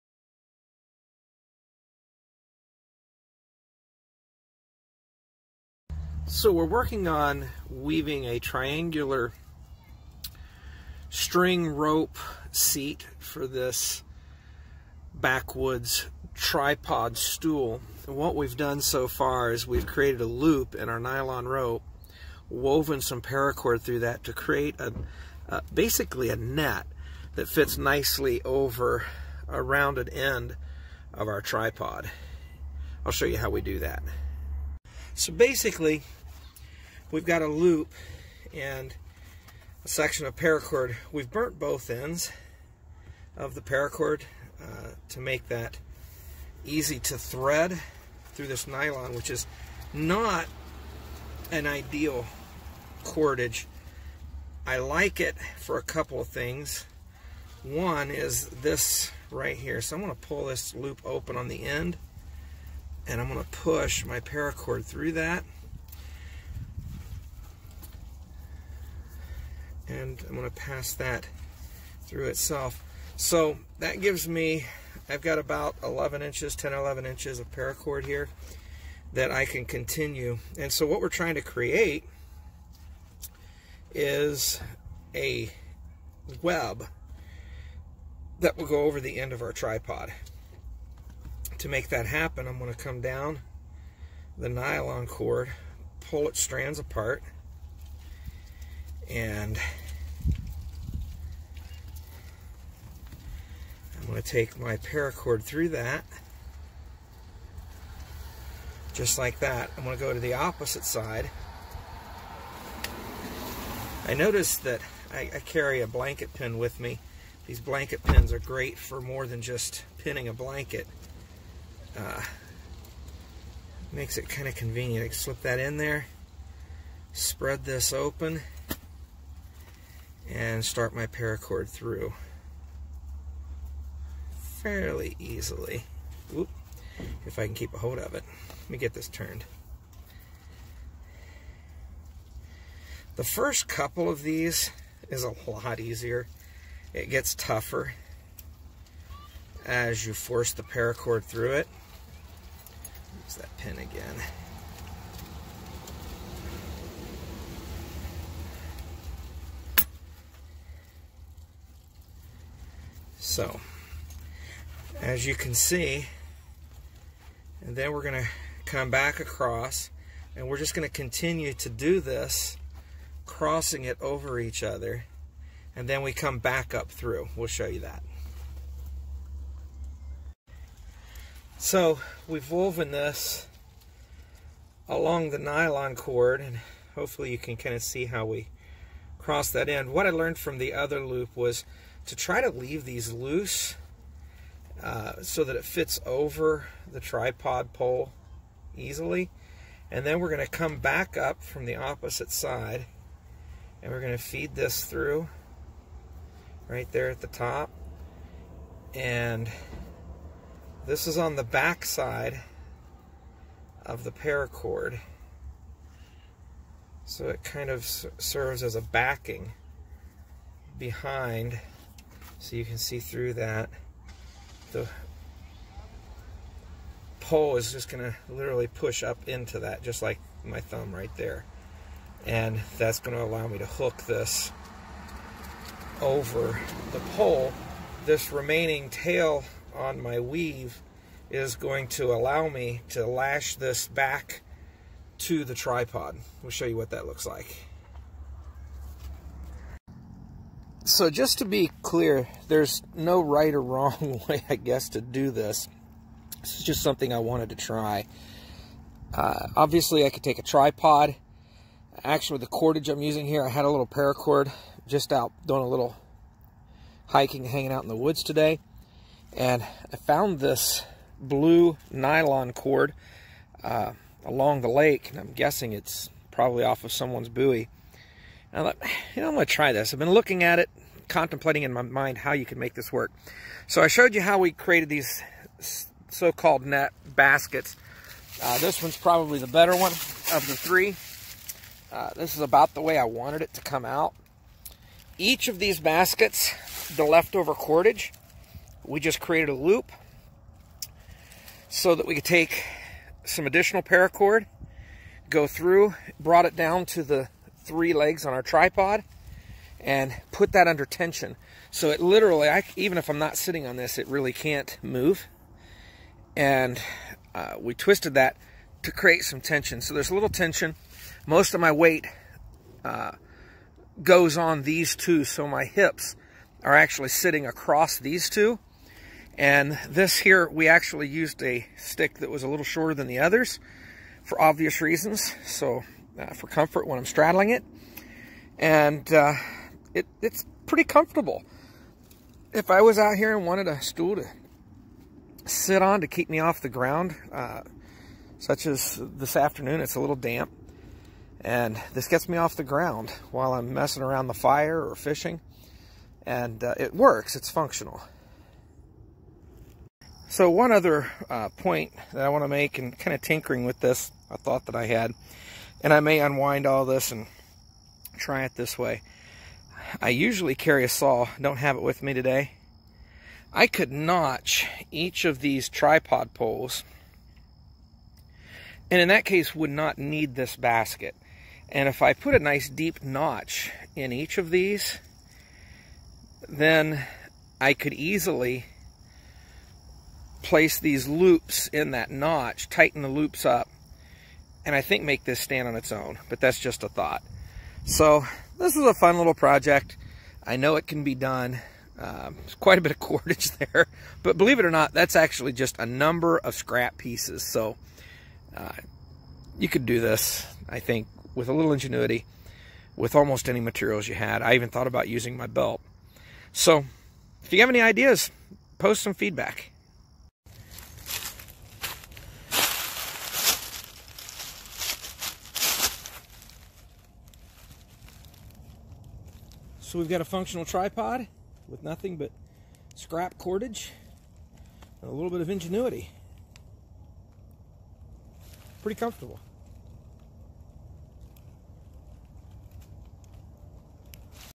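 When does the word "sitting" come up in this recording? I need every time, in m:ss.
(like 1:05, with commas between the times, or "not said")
5:13, 5:27.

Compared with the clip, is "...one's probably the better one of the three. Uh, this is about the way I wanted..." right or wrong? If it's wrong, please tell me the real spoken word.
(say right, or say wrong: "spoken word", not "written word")
right.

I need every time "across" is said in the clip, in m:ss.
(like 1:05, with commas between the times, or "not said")
2:49, 5:27.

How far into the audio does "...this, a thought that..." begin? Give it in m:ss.
6:03.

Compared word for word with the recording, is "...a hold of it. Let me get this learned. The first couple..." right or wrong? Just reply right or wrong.
wrong.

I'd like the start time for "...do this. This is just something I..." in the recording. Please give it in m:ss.
4:14.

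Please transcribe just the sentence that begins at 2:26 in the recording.
It gets tougher as you force the paracord through it.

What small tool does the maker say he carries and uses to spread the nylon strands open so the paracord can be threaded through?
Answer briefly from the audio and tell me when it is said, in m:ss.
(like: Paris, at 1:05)
blanket pin, at 1:55.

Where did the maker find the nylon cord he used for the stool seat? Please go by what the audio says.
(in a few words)
along the lake.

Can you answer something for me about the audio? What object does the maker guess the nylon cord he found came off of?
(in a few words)
someone's buoy.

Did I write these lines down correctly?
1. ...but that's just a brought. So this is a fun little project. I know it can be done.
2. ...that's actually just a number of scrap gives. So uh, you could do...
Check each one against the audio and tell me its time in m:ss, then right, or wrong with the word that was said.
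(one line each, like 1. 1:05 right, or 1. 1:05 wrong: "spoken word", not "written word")
1. 6:36 wrong: "thought", not "brought"
2. 6:44 wrong: "pieces", not "gives".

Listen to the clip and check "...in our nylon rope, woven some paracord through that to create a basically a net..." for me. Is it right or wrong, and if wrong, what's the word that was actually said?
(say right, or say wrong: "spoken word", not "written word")
right.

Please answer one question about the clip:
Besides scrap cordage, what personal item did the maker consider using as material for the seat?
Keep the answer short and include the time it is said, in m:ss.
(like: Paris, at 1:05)
belt, at 6:55.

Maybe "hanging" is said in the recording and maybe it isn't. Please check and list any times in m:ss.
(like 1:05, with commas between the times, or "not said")
4:27.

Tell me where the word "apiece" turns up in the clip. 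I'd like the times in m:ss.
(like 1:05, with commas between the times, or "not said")
not said.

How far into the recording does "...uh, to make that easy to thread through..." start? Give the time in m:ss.
0:44.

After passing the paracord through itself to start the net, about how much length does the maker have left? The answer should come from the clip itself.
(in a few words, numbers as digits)
10 or 11 inches.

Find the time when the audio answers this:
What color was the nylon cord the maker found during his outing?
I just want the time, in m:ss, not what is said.
4:31.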